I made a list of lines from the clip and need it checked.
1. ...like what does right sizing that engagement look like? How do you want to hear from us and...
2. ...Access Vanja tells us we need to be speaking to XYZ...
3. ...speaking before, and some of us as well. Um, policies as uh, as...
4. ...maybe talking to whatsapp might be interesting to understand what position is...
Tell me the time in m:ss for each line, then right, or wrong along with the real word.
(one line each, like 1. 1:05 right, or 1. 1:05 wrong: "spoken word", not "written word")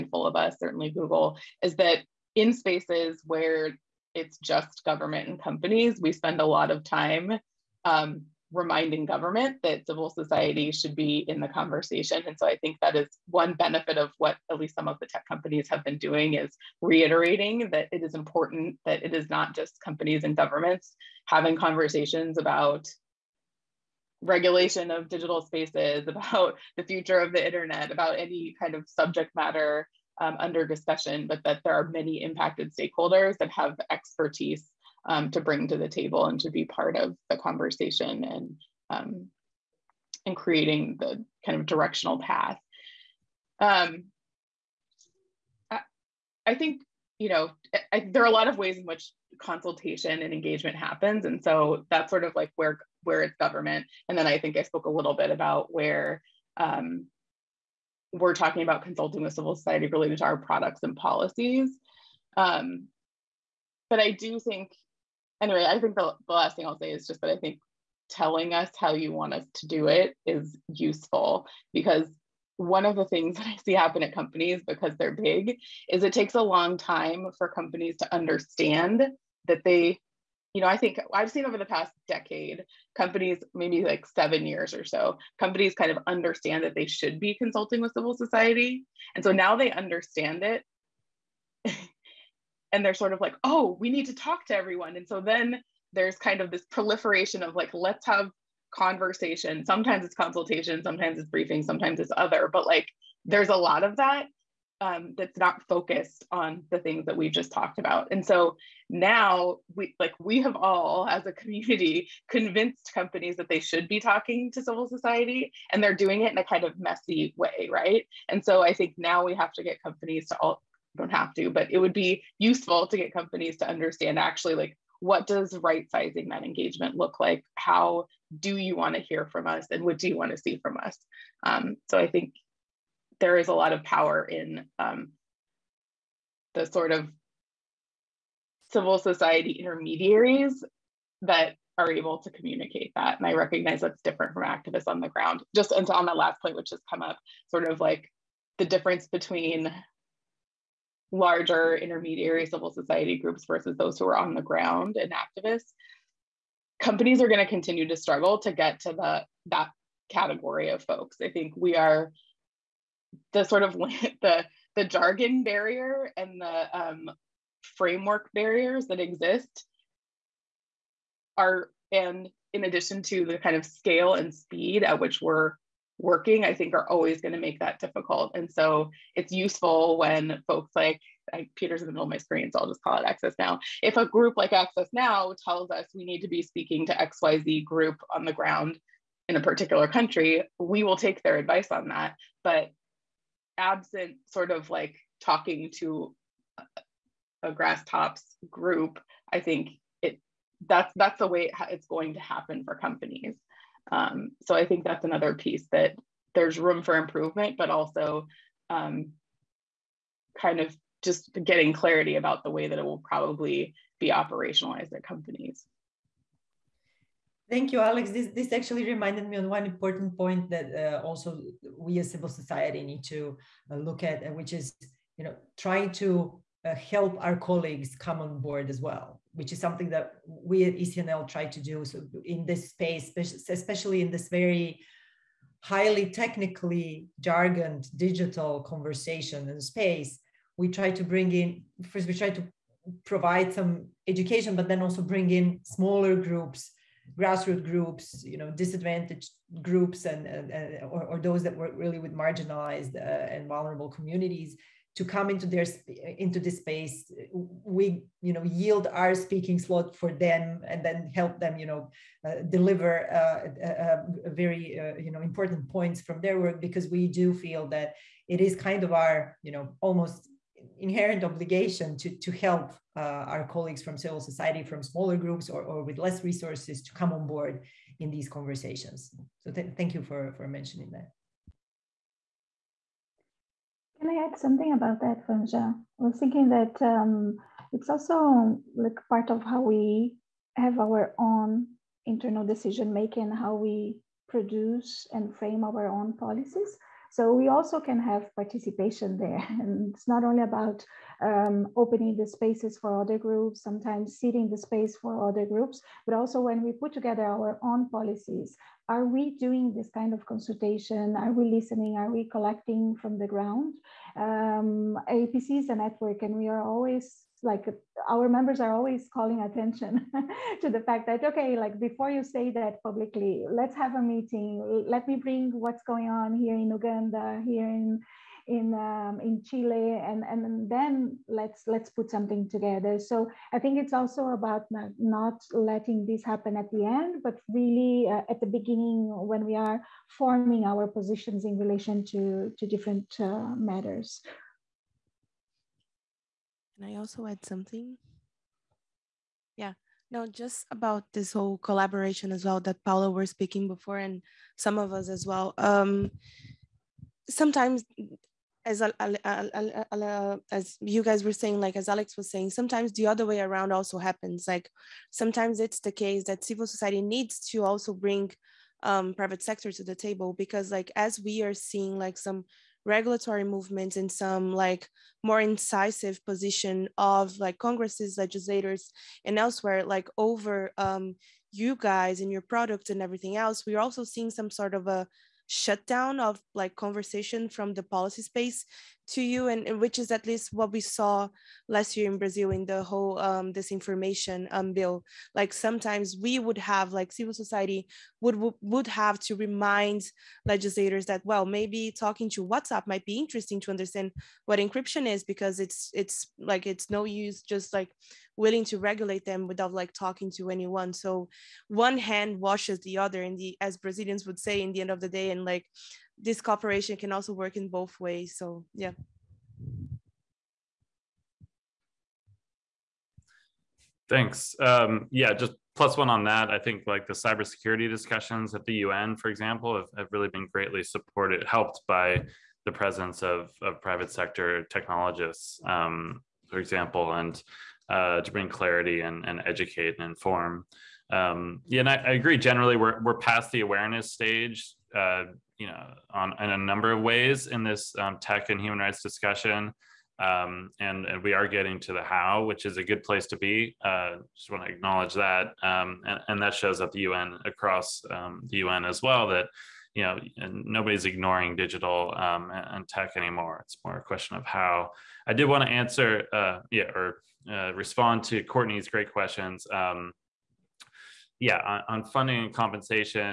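1. 2:04 right
2. 3:04 wrong: "Now", not "Vanja"
3. 5:53 wrong: "sometimes", not "policies"
4. 6:41 wrong: "encryption", not "position".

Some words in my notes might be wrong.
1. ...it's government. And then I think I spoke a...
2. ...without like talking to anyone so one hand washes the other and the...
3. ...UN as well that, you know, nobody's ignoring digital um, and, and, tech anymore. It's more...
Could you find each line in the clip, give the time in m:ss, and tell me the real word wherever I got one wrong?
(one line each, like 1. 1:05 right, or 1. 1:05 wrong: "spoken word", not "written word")
1. 0:53 right
2. 6:49 right
3. 7:38 right.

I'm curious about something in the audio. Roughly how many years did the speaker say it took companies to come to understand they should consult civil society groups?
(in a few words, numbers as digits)
7.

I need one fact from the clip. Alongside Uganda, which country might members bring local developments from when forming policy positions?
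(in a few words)
Chile.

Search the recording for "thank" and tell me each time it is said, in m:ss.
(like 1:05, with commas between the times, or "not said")
3:37, 4:39, 7:04.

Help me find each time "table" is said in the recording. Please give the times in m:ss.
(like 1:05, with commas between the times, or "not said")
0:35, 6:09.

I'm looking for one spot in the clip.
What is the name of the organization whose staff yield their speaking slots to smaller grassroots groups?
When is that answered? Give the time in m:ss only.
3:50.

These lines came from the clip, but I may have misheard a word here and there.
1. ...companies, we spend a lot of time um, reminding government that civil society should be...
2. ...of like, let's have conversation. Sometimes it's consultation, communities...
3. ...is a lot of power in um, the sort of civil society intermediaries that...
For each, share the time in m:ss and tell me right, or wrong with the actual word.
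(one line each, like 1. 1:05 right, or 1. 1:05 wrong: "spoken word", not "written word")
1. 0:05 right
2. 1:37 wrong: "sometimes", not "communities"
3. 2:13 right.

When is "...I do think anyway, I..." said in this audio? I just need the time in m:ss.
1:03.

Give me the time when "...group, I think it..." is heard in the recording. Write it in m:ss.
3:18.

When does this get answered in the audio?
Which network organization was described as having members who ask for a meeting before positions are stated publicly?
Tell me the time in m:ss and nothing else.
5:15.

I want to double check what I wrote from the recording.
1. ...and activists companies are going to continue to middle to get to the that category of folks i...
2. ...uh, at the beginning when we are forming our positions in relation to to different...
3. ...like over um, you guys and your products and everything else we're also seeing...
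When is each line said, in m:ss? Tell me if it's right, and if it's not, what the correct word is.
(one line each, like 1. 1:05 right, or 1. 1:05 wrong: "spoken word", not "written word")
1. 2:34 wrong: "struggle", not "middle"
2. 5:38 right
3. 6:19 right.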